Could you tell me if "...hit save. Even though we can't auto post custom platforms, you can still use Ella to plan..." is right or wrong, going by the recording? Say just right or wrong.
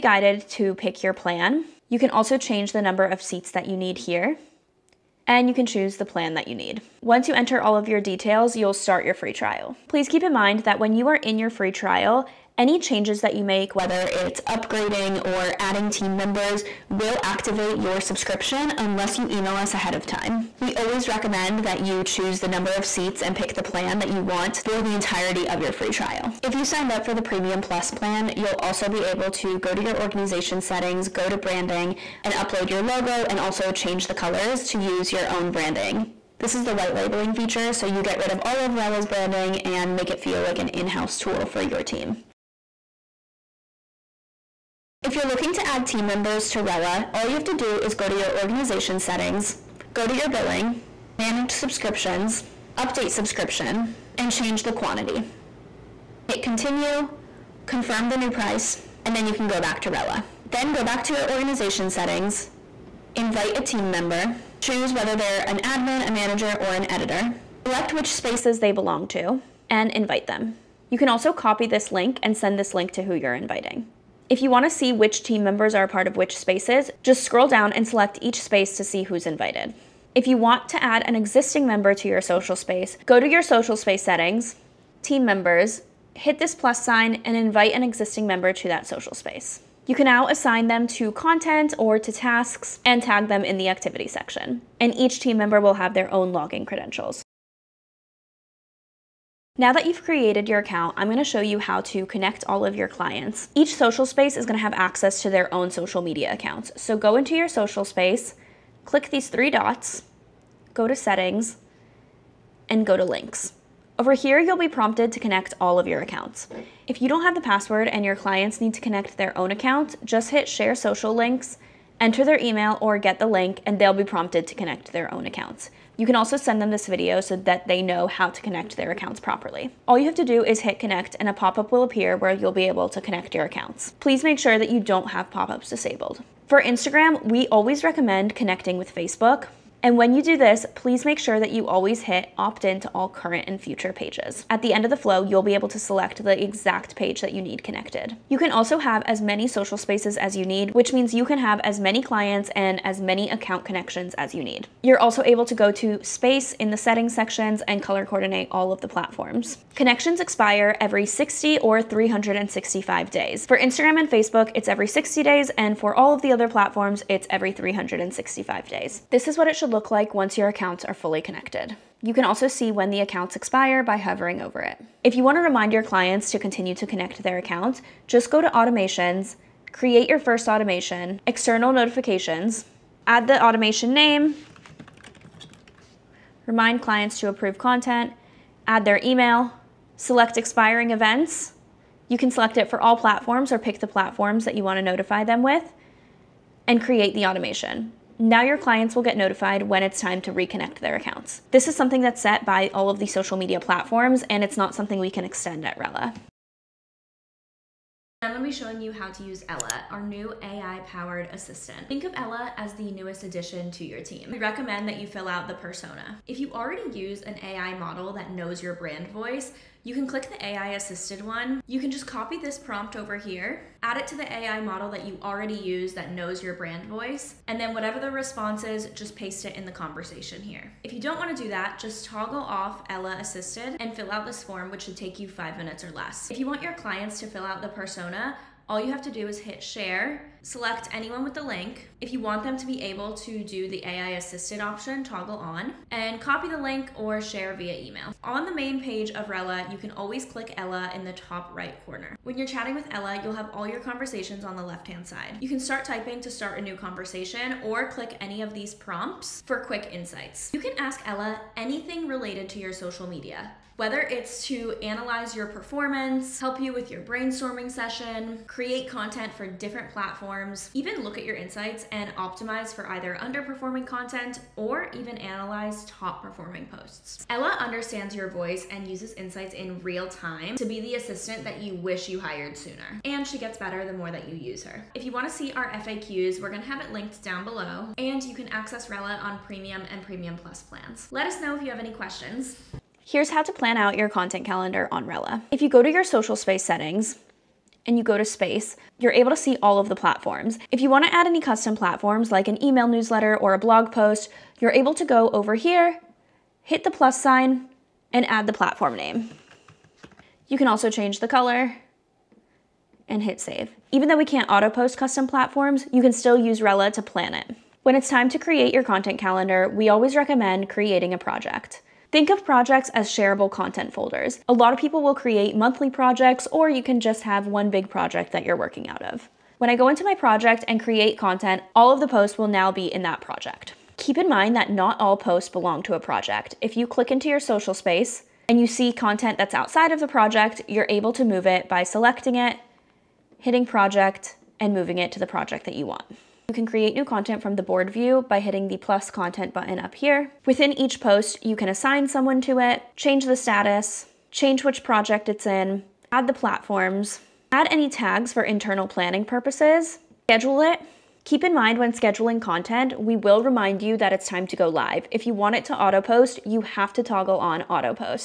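wrong.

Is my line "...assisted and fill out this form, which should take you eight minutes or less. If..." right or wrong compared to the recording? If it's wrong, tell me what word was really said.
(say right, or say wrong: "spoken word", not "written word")
wrong: "five", not "eight".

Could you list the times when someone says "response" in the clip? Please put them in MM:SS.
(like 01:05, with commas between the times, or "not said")
03:48.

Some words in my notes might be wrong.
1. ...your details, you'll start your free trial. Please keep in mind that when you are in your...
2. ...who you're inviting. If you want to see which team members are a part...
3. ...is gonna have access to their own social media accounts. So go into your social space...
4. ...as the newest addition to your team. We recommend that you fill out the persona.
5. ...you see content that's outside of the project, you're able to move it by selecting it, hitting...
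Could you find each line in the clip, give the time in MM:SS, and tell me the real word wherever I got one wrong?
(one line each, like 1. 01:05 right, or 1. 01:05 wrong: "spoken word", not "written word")
1. 00:07 right
2. 01:13 right
3. 01:44 right
4. 03:32 right
5. 05:38 right.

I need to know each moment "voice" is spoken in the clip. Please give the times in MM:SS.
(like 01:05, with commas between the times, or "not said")
03:39, 03:46, 04:38.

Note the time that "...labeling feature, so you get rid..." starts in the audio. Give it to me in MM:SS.
00:36.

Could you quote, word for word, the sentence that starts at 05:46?
You can create new content from the board view by hitting the plus content button up here.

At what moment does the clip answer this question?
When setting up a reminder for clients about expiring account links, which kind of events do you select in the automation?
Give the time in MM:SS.
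03:10.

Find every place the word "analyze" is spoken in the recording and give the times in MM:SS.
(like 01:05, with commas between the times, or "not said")
04:24, 04:35.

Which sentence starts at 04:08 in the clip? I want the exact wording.
On the main page of Rella, you can always click Ella in the top right corner.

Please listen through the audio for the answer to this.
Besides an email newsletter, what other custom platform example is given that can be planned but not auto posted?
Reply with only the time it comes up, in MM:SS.
05:03.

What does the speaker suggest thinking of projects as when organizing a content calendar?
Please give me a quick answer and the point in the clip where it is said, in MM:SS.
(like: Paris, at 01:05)
Shareable content folders, at 05:23.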